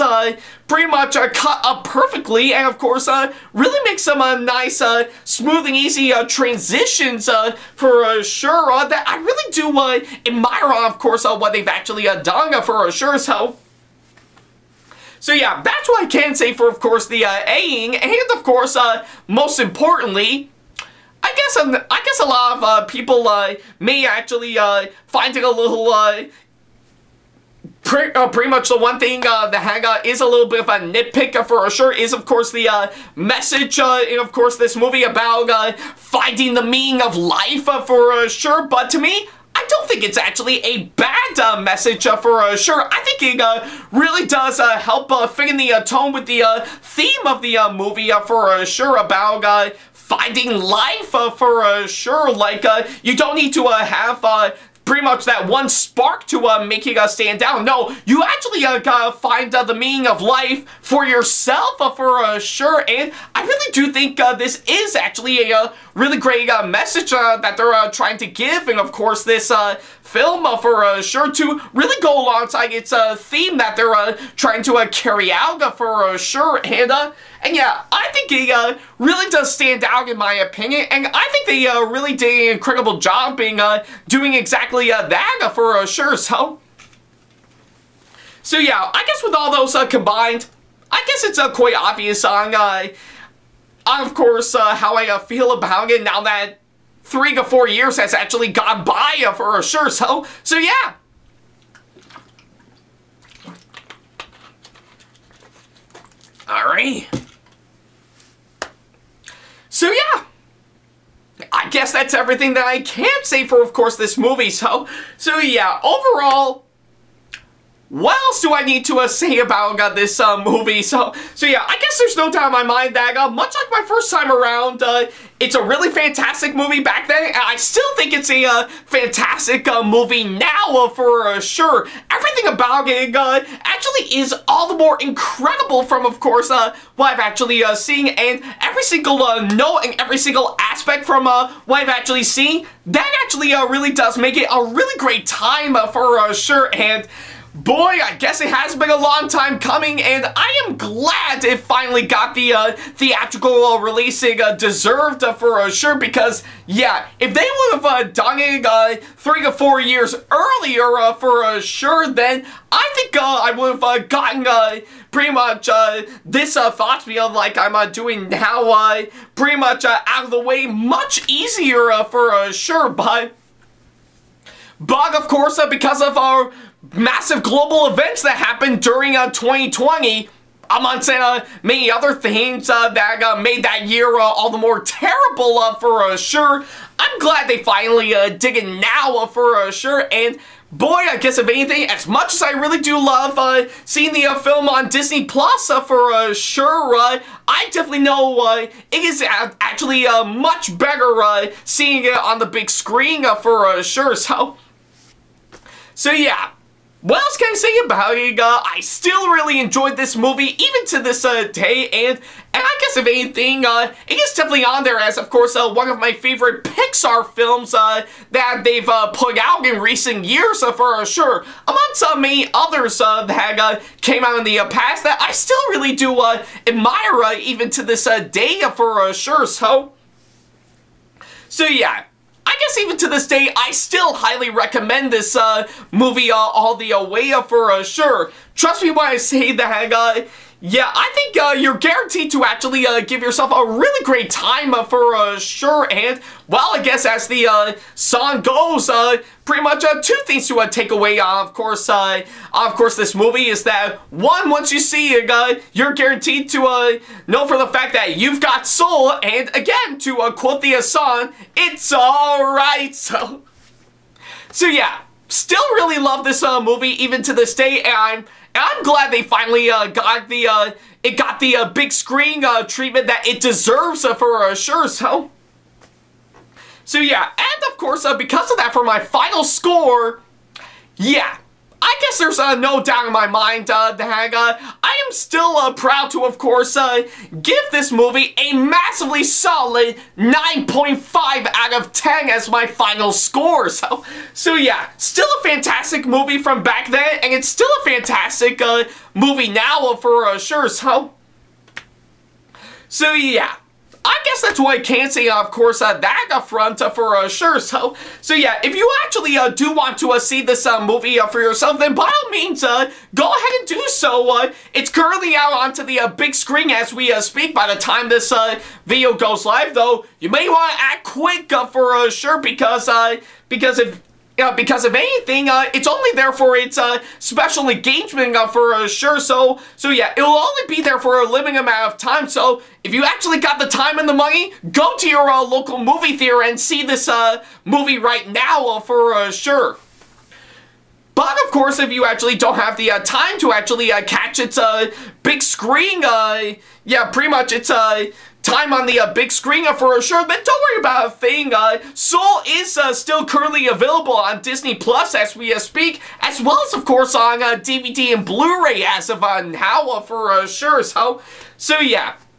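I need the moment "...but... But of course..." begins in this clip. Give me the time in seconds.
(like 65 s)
172 s.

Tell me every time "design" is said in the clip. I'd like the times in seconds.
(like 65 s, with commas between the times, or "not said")
not said.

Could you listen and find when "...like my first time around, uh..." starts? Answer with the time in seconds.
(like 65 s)
123 s.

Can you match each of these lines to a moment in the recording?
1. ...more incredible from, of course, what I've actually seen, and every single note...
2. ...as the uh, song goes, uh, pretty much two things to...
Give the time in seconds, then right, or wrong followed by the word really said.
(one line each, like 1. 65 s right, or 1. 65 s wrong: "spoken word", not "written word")
1. 134 s right
2. 247 s right.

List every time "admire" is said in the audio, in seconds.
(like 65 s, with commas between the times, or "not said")
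10 s, 226 s.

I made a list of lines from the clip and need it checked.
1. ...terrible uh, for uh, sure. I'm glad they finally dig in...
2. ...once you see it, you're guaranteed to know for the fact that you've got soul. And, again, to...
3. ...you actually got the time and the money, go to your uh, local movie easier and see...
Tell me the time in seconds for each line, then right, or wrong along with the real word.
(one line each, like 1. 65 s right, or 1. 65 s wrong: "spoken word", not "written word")
1. 184 s right
2. 254 s right
3. 332 s wrong: "theater", not "easier".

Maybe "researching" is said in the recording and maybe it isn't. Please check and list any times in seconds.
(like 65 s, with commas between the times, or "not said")
not said.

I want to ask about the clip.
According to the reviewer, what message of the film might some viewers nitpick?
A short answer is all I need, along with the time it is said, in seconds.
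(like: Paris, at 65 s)
finding the meaning of life, at 35 s.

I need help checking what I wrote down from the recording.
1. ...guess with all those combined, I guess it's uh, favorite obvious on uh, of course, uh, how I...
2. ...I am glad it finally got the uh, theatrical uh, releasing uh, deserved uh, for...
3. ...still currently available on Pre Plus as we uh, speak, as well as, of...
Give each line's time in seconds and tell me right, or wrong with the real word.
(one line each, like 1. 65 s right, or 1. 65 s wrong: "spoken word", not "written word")
1. 89 s wrong: "quite", not "favorite"
2. 150 s right
3. 352 s wrong: "Disney", not "Pre".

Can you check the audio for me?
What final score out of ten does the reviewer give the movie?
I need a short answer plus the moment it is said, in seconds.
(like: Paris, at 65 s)
9.5, at 290 s.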